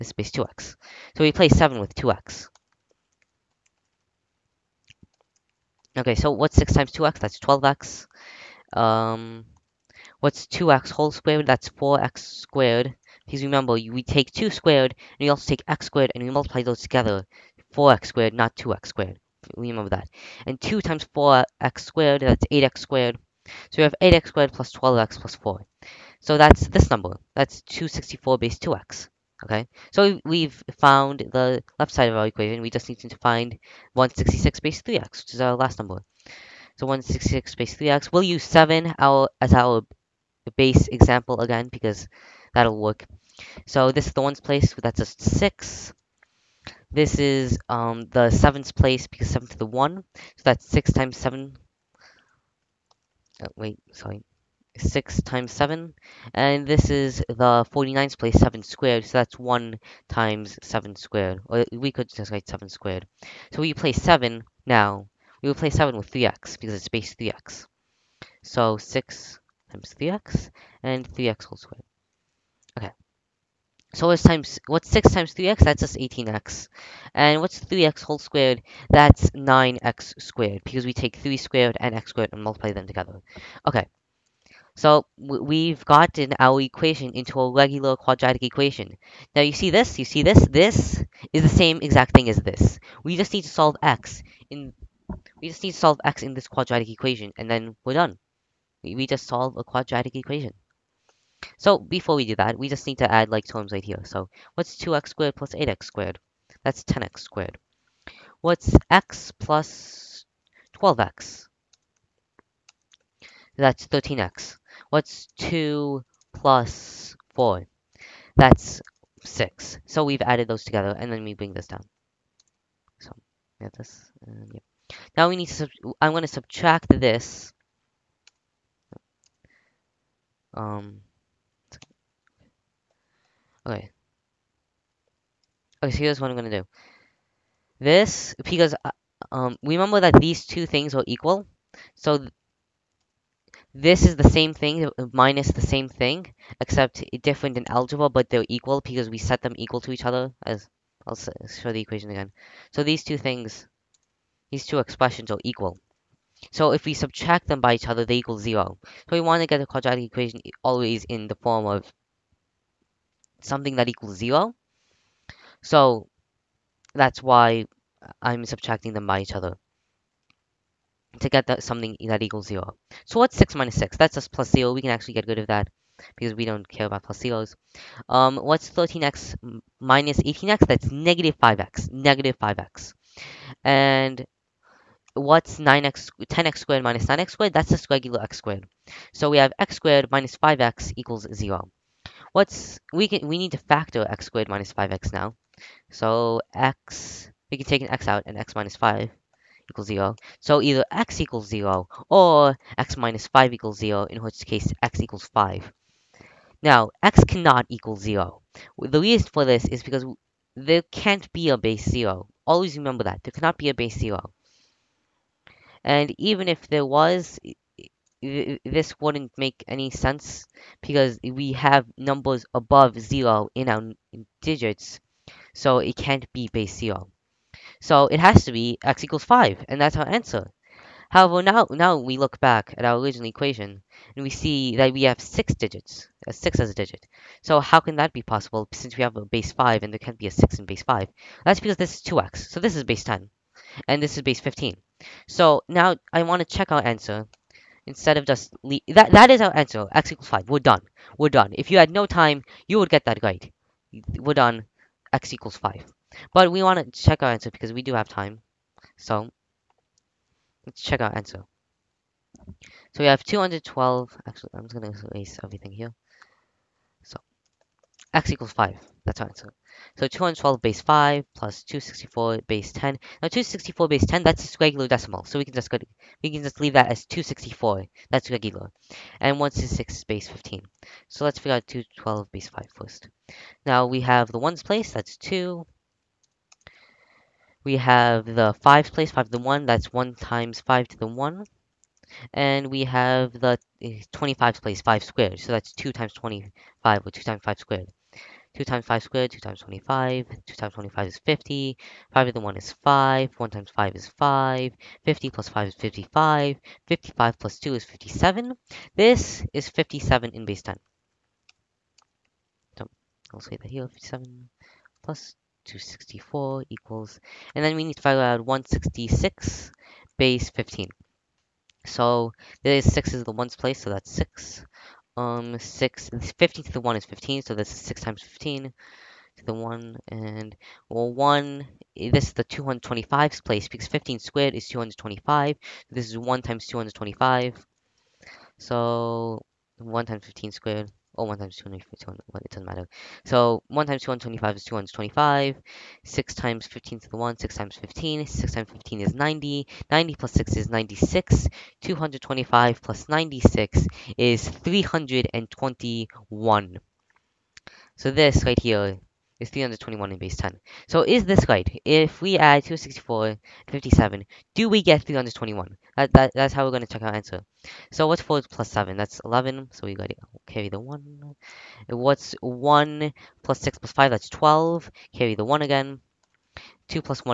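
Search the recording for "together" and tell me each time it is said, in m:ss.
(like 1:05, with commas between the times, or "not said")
0:16, 1:22, 2:00.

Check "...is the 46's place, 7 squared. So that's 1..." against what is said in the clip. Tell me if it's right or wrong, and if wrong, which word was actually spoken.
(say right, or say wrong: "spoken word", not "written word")
wrong: "49", not "46".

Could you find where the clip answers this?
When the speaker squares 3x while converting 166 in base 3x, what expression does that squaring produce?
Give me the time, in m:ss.
1:18.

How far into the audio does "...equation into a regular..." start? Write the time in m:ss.
1:26.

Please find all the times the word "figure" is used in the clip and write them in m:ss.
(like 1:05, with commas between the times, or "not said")
4:41, 5:18.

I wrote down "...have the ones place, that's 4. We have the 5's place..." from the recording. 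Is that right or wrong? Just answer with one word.
wrong.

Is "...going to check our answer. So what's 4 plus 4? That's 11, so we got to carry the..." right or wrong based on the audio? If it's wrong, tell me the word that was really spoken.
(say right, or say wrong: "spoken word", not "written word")
wrong: "7", not "4".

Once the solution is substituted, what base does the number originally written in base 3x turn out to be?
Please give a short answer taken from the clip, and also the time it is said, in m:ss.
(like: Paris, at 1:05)
15, at 4:04.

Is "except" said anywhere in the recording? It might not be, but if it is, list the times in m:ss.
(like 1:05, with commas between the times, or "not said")
2:26.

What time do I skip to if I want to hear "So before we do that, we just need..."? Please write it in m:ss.
1:41.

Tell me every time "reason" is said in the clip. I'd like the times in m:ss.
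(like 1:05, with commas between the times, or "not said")
3:28.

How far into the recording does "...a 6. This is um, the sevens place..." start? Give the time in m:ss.
0:44.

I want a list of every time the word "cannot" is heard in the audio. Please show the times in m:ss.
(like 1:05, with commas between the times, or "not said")
3:27, 3:33.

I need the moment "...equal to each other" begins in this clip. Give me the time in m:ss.
2:29.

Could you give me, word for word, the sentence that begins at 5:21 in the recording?
So is 6 is the ones place, so that's 6.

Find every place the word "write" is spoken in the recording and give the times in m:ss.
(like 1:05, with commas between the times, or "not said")
1:02.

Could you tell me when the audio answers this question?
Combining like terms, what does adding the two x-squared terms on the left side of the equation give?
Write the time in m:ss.
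1:46.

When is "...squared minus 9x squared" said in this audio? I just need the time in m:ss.
3:06.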